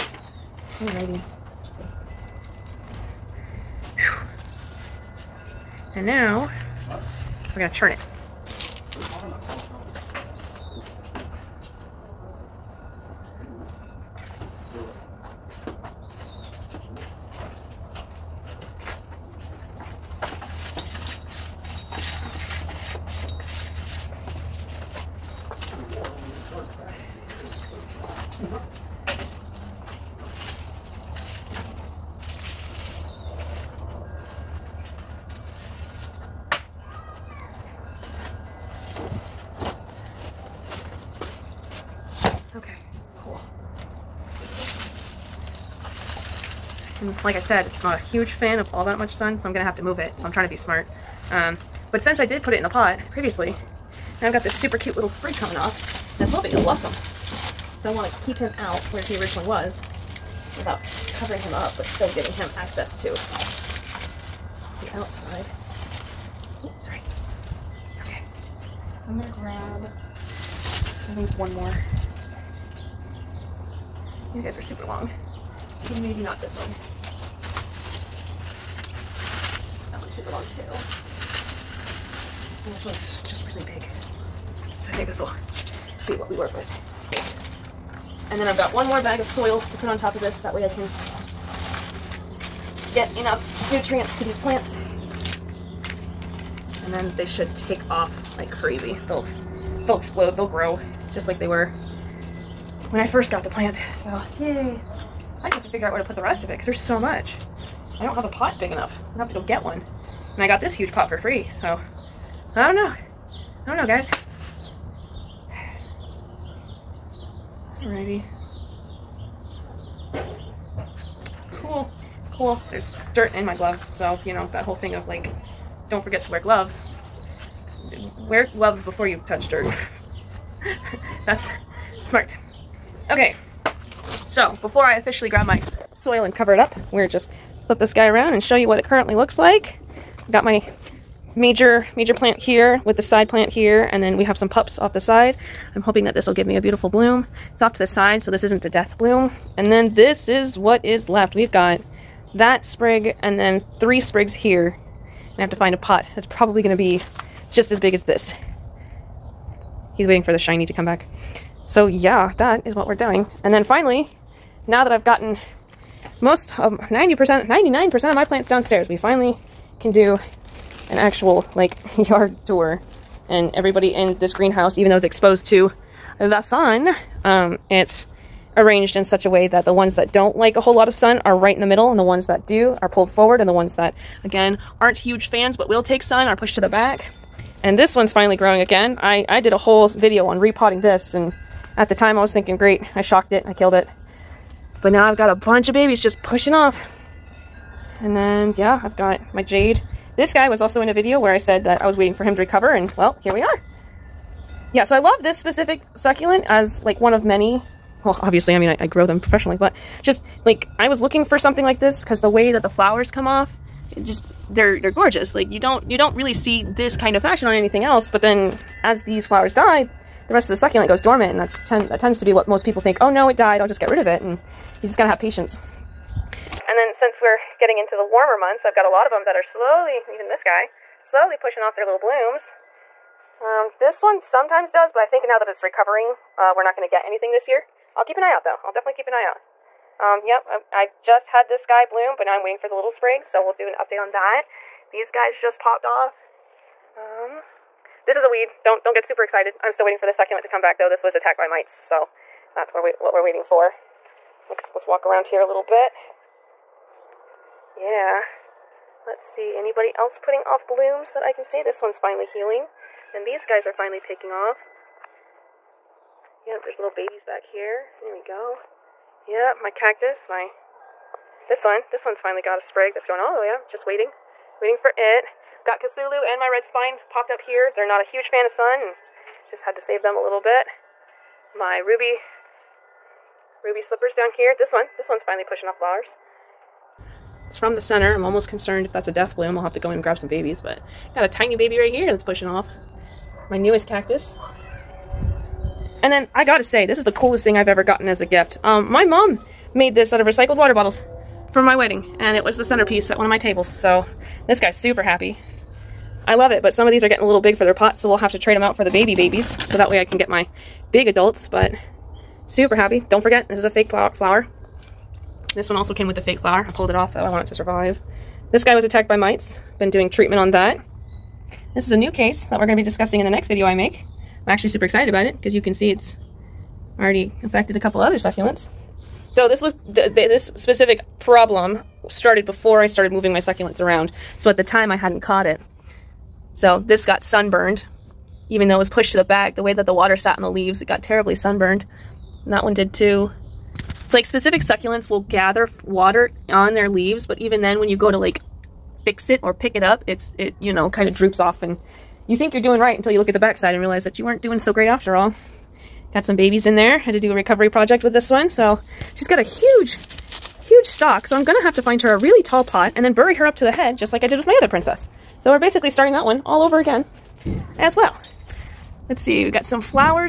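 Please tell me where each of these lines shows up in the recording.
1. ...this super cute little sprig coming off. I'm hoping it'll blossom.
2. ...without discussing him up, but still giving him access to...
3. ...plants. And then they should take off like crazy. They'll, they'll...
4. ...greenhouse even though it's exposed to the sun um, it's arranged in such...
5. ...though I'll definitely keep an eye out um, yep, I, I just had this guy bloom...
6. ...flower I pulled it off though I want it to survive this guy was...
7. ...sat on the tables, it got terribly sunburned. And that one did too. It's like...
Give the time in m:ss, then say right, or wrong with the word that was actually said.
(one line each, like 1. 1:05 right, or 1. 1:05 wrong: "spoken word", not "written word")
1. 0:54 right
2. 1:00 wrong: "covering", not "discussing"
3. 1:34 right
4. 2:54 right
5. 3:58 right
6. 5:16 right
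7. 5:40 wrong: "leaves", not "tables".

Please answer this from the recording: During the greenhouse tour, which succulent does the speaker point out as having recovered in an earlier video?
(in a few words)
Jade.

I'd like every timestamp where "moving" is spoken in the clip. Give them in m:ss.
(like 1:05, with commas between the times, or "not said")
5:33.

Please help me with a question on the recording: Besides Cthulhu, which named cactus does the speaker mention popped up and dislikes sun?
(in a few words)
Red spine.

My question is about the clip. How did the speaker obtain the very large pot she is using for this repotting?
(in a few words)
For free.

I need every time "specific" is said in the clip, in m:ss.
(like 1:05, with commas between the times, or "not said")
3:25, 5:30, 5:44.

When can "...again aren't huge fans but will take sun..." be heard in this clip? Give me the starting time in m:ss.
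3:04.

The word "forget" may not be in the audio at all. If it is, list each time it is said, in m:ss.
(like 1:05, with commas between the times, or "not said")
2:06, 5:13.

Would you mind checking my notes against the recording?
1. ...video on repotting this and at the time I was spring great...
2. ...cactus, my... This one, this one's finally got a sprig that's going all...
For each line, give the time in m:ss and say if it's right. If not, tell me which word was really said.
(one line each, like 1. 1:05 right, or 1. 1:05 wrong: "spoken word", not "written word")
1. 3:09 wrong: "thinking", not "spring"
2. 4:29 right.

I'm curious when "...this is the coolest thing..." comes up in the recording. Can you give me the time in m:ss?
4:56.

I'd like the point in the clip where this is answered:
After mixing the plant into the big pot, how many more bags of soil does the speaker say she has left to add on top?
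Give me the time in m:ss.
1:28.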